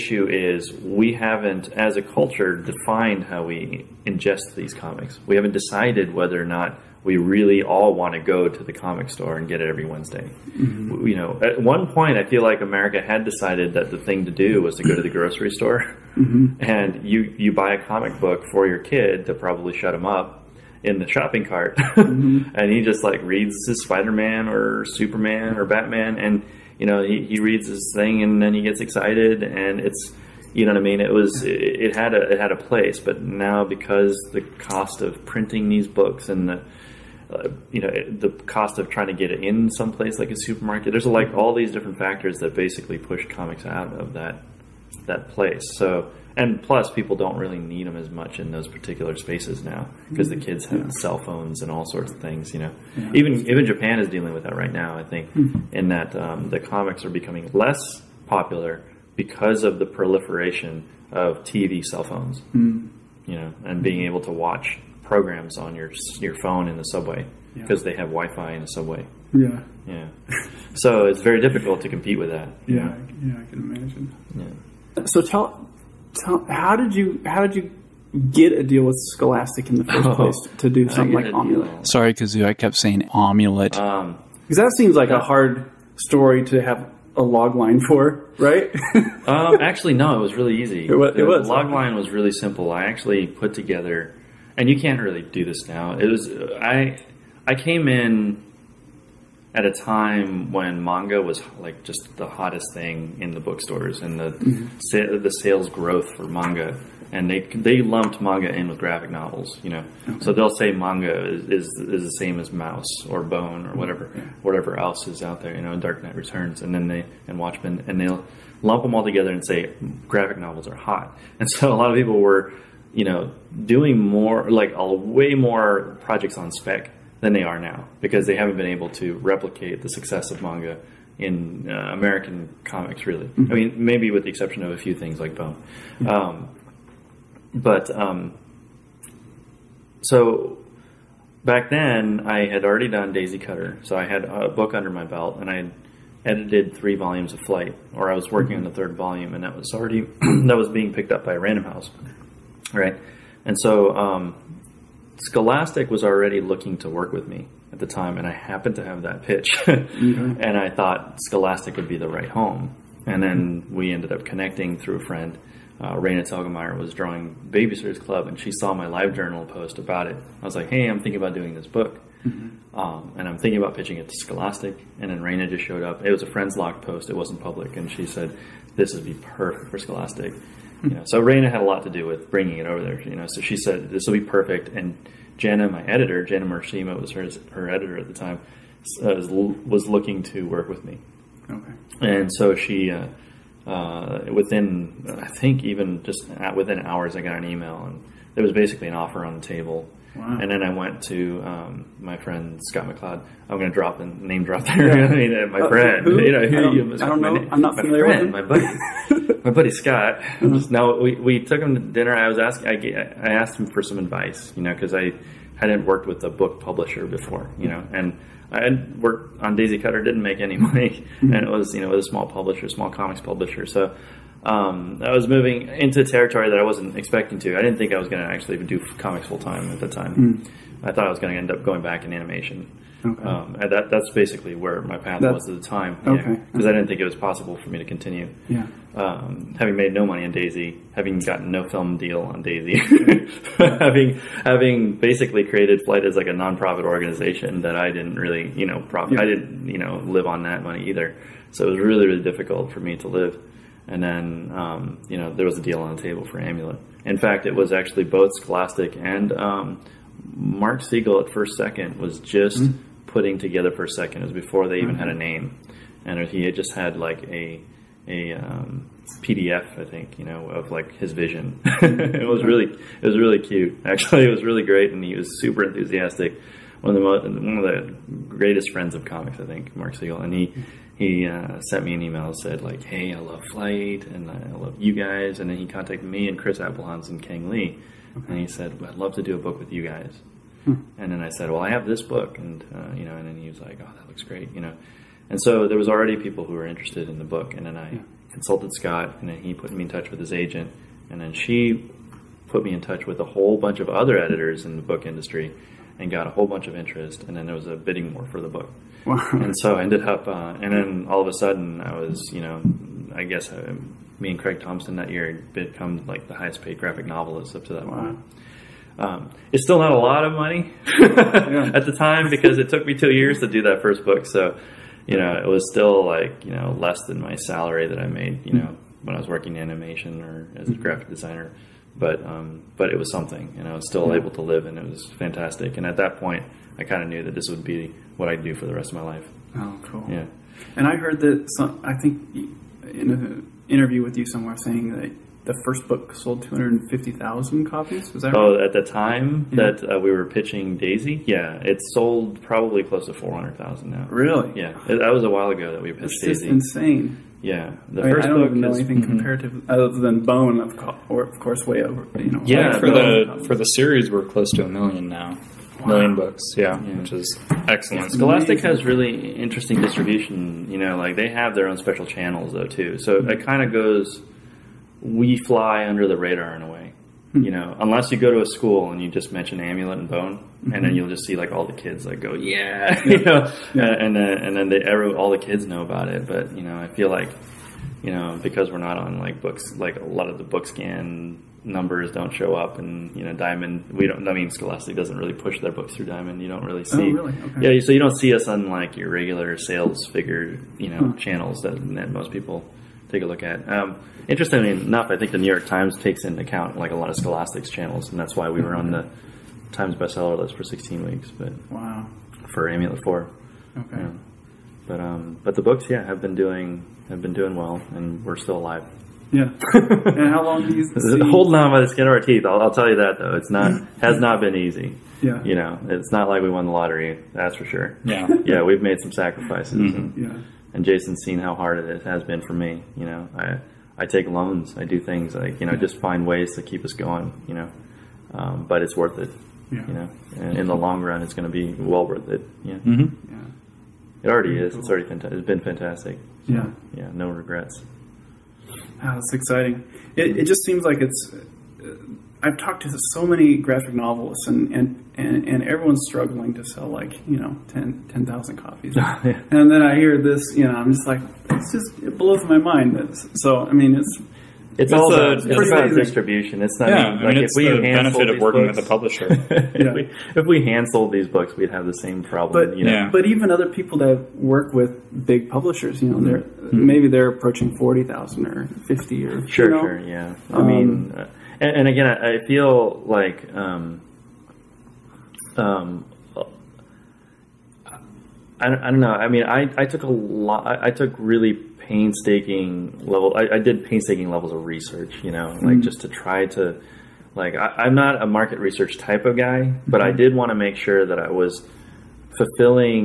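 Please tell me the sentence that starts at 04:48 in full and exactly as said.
and he said, well, "I'd love to do a book with you guys." Hmm.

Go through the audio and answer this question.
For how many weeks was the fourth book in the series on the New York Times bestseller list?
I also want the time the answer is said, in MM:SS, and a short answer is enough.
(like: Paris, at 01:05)
16, at 06:50.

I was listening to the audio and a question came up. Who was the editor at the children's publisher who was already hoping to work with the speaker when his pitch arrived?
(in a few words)
Jana Marshima.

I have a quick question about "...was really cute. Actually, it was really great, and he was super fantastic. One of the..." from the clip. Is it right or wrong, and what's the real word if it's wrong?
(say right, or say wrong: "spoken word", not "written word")
wrong: "enthusiastic", not "fantastic".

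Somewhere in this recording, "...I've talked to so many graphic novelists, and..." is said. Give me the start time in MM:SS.
07:32.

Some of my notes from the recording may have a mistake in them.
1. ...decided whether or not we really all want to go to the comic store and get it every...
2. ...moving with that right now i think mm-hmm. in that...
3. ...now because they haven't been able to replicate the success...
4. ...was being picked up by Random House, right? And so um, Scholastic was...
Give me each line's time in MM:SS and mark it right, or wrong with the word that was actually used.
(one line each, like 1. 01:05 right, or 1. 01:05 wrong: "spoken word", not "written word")
1. 00:05 right
2. 00:54 wrong: "dealing", not "moving"
3. 02:07 right
4. 02:30 right.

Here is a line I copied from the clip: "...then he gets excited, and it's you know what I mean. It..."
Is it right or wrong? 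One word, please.
right.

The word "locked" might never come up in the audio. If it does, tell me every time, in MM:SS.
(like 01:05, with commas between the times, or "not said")
02:56.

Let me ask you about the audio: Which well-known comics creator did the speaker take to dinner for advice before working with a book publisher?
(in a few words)
Scott McCloud.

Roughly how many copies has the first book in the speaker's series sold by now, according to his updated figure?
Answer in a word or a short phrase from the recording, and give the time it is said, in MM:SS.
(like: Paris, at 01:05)
400,000, at 05:53.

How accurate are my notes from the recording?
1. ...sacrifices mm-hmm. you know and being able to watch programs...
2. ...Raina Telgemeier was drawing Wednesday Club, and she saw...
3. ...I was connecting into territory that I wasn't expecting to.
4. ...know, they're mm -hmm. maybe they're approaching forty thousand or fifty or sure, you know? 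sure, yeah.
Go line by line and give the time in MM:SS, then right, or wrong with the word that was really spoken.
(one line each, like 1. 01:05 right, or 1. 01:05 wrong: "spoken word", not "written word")
1. 01:02 wrong: "phones", not "sacrifices"
2. 02:45 wrong: "Babysitters", not "Wednesday"
3. 03:45 wrong: "moving", not "connecting"
4. 07:56 right.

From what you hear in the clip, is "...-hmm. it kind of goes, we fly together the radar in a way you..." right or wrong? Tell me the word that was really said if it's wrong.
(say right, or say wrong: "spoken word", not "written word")
wrong: "under", not "together".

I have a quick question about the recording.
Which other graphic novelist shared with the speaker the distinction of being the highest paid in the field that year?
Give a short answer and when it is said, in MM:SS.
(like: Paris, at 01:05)
Craig Thompson, at 05:14.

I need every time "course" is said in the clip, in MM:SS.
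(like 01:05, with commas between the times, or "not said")
06:01.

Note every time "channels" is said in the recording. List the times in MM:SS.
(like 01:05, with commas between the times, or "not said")
06:12, 06:41, 06:47.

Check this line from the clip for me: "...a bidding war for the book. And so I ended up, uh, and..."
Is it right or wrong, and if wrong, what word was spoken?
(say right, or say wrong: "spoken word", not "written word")
right.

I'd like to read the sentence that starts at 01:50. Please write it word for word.
so they'll say manga is, is, is the same as mouse or bone or whatever yeah.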